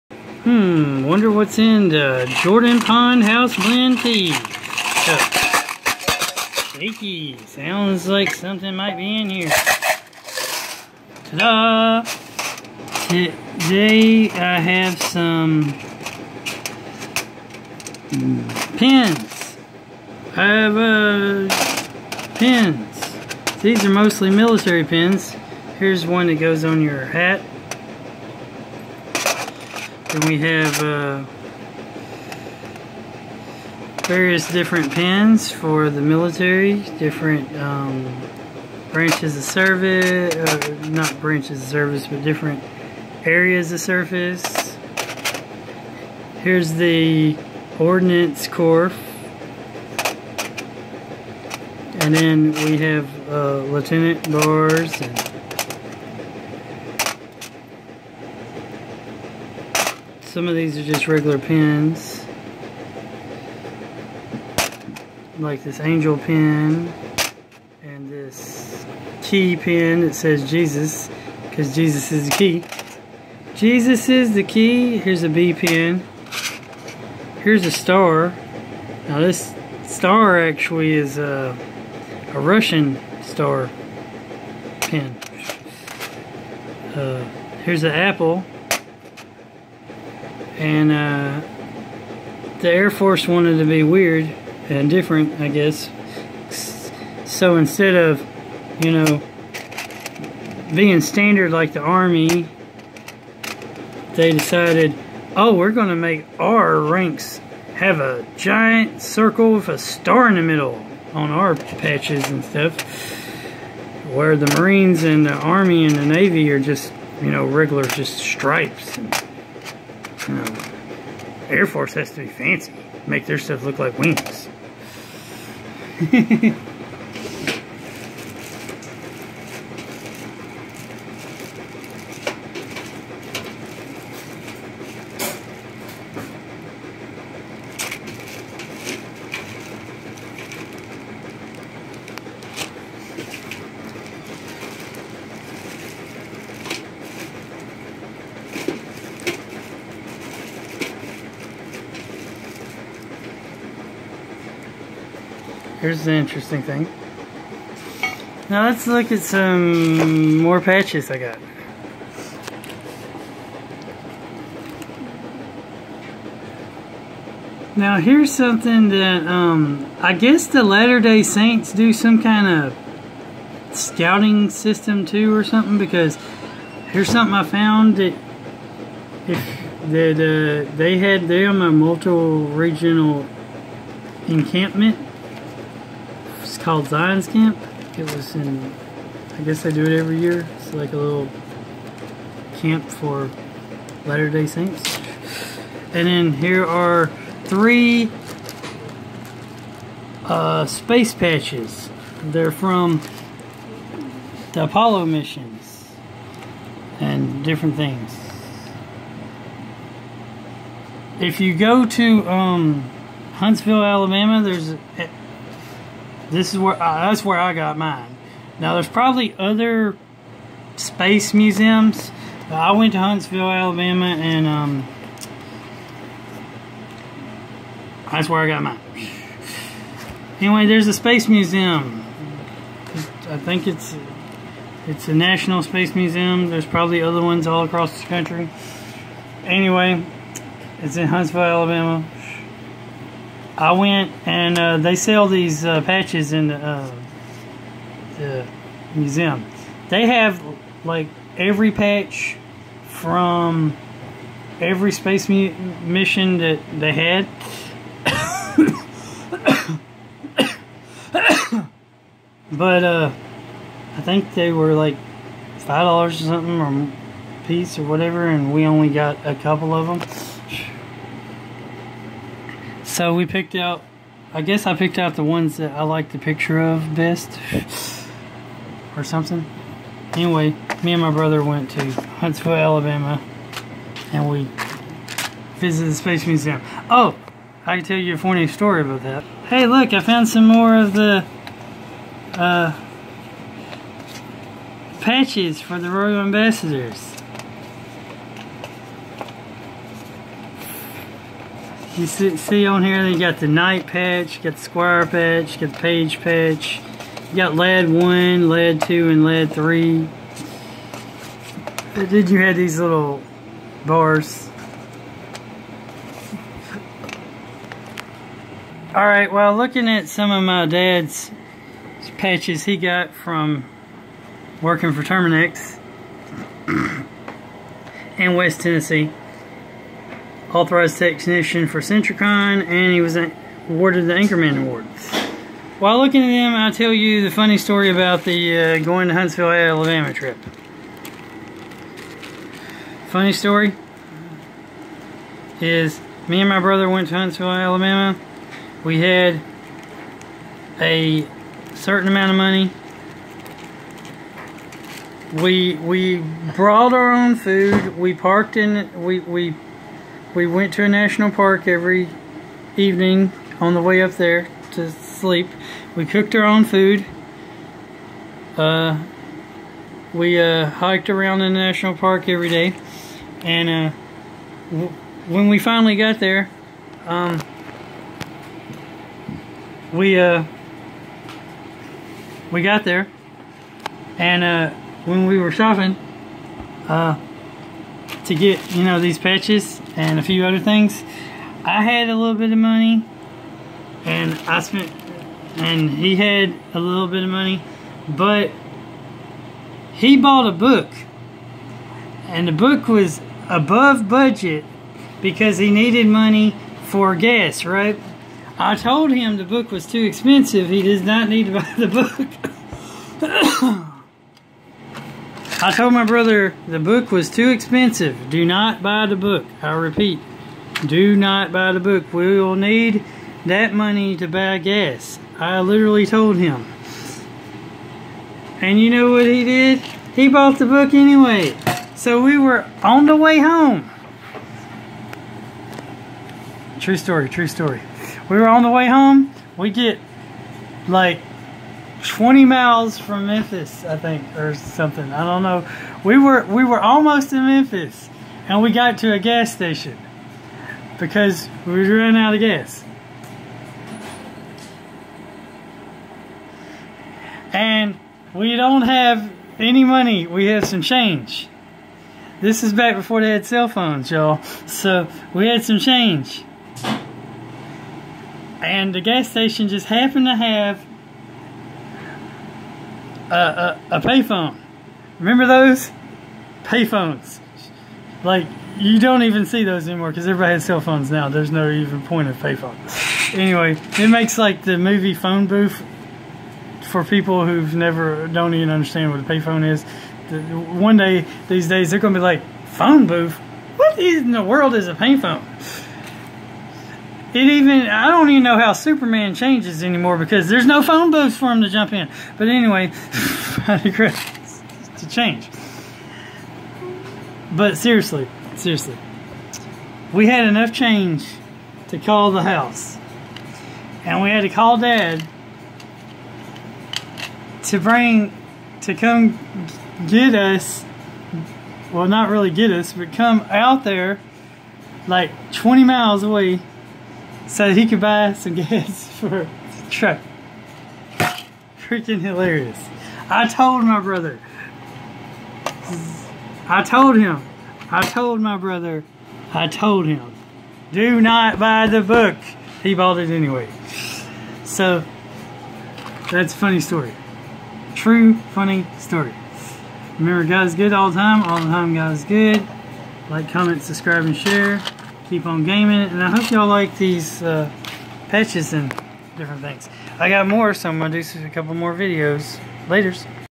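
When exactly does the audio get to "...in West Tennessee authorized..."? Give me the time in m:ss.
5:28.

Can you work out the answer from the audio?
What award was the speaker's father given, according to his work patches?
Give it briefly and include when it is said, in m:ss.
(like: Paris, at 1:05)
Anchorman Award, at 5:34.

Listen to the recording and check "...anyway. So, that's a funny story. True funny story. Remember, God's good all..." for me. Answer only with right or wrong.
right.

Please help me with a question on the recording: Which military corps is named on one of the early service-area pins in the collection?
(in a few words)
Ordnance Corps.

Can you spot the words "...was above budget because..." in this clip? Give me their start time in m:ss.
6:42.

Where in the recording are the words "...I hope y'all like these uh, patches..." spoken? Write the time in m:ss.
9:16.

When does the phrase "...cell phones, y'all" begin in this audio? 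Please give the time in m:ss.
7:43.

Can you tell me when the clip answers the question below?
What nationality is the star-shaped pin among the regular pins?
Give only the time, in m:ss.
1:22.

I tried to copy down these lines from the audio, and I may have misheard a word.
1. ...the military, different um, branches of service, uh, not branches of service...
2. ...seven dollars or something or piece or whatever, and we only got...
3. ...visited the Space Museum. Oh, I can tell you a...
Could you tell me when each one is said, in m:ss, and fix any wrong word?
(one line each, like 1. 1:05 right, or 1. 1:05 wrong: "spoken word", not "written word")
1. 0:35 right
2. 4:25 wrong: "five", not "seven"
3. 4:45 right.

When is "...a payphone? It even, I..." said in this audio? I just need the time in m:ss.
8:14.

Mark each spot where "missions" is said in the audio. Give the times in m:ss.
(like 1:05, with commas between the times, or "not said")
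3:25, 4:15.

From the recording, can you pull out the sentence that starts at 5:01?
You see, see on here, they got the knight patch, you got the square patch, you got the page patch.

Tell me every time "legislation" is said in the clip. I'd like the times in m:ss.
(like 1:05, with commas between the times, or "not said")
not said.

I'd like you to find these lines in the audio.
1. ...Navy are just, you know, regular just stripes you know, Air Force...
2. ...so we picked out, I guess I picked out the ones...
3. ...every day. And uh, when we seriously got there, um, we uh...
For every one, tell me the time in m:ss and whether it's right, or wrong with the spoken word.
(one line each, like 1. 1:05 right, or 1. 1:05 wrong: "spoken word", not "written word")
1. 1:56 right
2. 4:33 right
3. 6:12 wrong: "finally", not "seriously".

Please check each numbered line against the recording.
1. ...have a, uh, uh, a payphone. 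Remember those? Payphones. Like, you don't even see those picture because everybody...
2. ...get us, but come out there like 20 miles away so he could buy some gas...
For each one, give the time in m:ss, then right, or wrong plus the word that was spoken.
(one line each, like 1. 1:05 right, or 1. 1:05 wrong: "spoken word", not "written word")
1. 7:50 wrong: "anymore", not "picture"
2. 8:42 right.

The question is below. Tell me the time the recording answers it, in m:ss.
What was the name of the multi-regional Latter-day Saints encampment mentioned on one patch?
3:06.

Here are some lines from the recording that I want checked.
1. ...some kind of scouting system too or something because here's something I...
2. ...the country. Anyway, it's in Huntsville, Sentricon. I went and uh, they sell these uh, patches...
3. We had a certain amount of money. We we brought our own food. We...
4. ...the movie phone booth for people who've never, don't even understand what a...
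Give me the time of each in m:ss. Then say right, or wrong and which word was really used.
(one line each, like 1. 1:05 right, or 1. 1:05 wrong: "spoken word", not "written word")
1. 2:51 right
2. 3:57 wrong: "Alabama", not "Sentricon"
3. 5:48 right
4. 8:04 right.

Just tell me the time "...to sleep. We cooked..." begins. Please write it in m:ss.
6:04.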